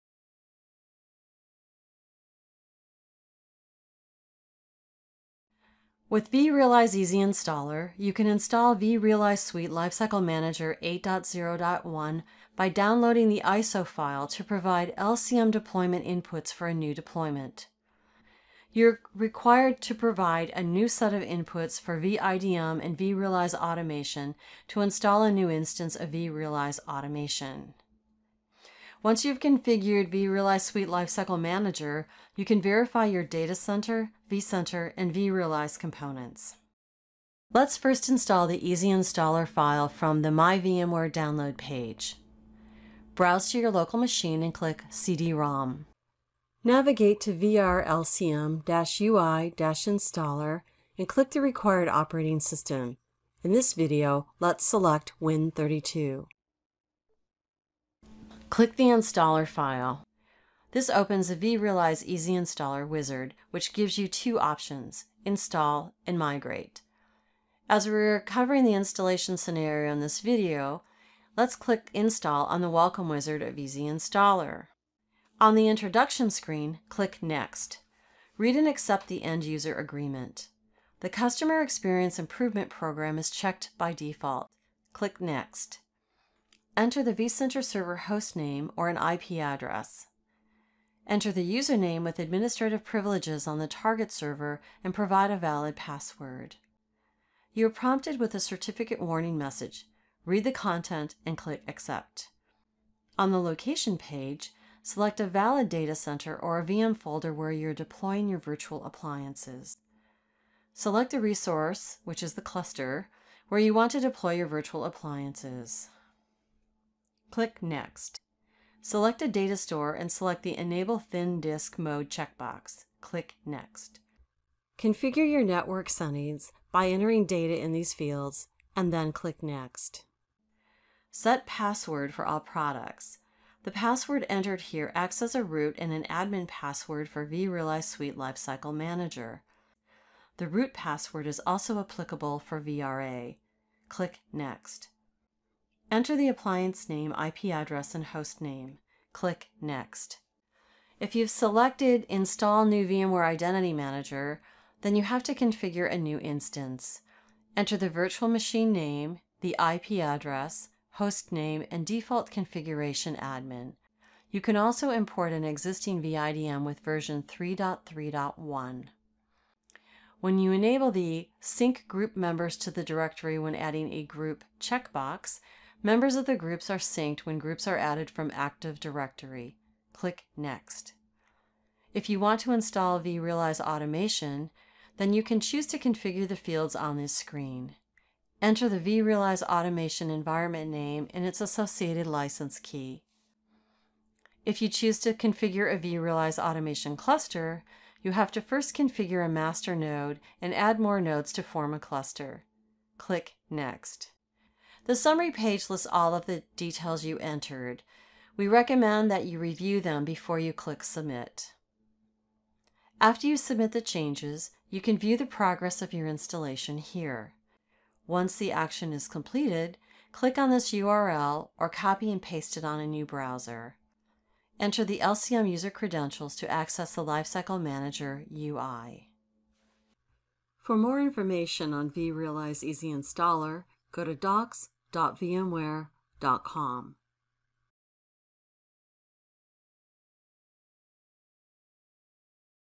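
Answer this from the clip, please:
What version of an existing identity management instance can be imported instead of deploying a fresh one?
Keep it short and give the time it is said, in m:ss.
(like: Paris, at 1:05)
3.3.1, at 2:47.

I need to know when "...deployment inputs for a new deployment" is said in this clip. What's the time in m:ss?
0:15.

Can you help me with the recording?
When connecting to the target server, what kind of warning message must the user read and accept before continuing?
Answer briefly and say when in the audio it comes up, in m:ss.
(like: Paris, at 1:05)
certificate warning, at 1:38.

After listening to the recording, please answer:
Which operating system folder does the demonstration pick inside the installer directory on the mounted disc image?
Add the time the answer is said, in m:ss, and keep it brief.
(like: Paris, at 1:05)
Win32, at 0:55.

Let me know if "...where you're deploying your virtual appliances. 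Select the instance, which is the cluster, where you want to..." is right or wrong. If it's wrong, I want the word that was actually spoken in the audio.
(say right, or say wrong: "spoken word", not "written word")
wrong: "resource", not "instance".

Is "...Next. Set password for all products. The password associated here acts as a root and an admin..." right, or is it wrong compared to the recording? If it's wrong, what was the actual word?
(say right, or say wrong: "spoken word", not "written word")
wrong: "entered", not "associated".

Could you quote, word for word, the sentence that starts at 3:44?
Enter the LCM user credentials to access the Lifecycle Manager UI.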